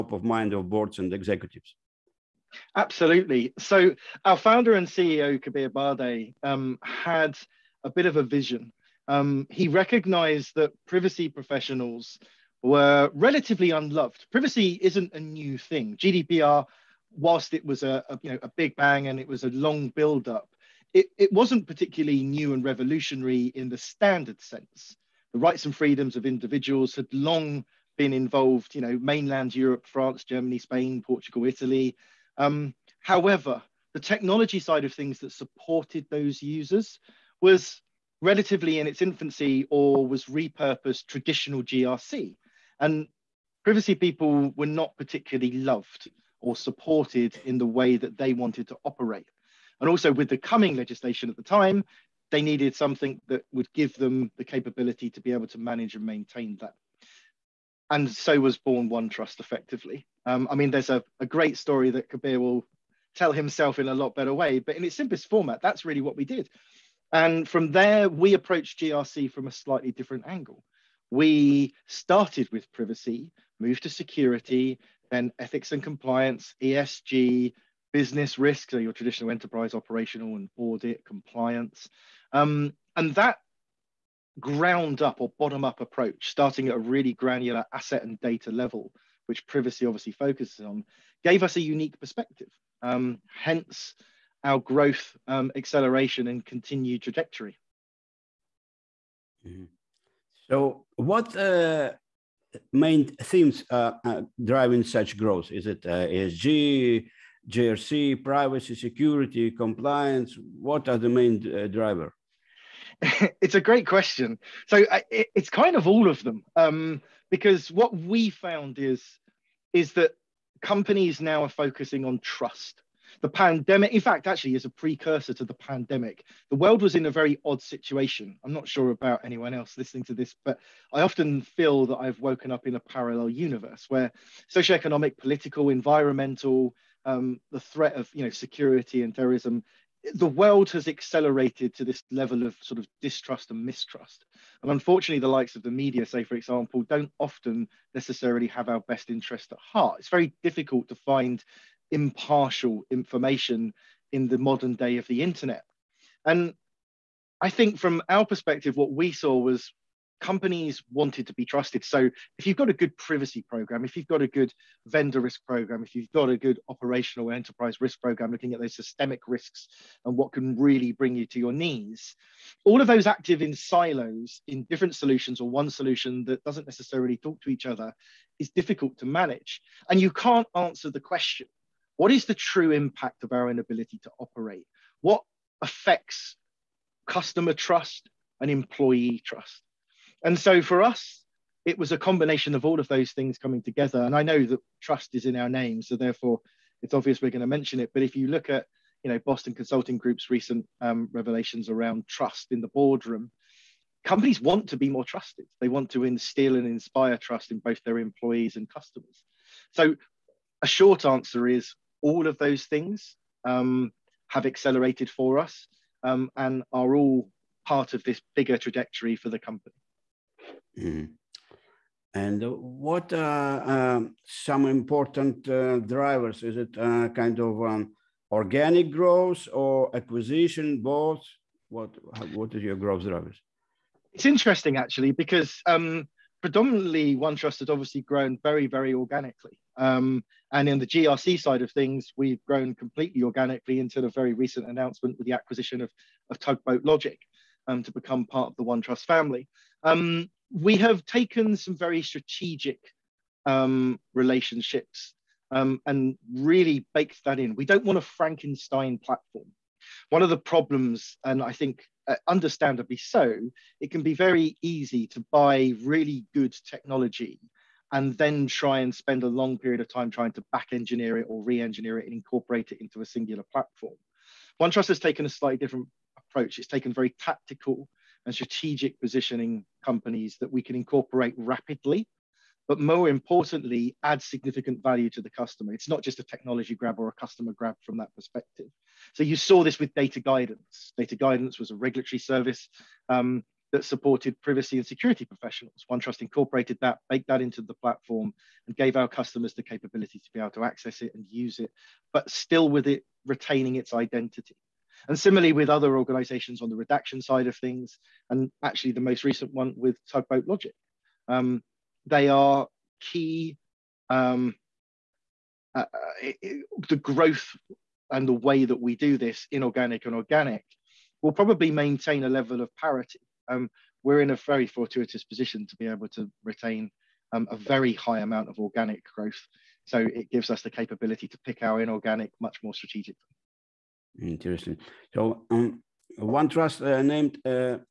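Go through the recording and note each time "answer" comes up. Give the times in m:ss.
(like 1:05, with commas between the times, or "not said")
3:00, 3:31.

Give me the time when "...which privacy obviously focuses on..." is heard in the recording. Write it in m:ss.
1:29.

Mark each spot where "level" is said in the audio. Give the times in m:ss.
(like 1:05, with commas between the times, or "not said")
1:28, 2:22, 5:22.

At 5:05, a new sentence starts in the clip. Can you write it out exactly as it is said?
And similarly with other organizations on the redaction side of things, and actually the most recent one with Tugboat Logic.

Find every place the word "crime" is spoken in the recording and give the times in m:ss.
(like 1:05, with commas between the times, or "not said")
not said.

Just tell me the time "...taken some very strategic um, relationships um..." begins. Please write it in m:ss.
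4:11.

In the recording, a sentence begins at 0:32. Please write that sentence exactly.
Um, however, the technology side of things that supported those users was relatively in its infancy or was repurposed traditional GRC.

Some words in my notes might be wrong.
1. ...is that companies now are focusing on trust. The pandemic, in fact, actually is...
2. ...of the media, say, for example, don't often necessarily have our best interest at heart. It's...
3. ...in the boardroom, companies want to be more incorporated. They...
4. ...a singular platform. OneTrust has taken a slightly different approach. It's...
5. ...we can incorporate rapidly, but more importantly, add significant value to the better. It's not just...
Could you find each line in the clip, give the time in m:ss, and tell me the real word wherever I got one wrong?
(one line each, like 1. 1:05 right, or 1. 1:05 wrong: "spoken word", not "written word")
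1. 1:59 right
2. 2:25 right
3. 3:22 wrong: "trusted", not "incorporated"
4. 4:32 right
5. 4:40 wrong: "customer", not "better".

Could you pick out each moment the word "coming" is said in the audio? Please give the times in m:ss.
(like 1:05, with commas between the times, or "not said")
0:50, 3:13.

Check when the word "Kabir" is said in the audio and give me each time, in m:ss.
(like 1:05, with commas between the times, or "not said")
0:05, 1:02.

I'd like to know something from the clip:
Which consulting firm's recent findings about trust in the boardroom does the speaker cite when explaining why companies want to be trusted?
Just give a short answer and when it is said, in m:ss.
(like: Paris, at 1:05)
Boston Consulting Group, at 3:19.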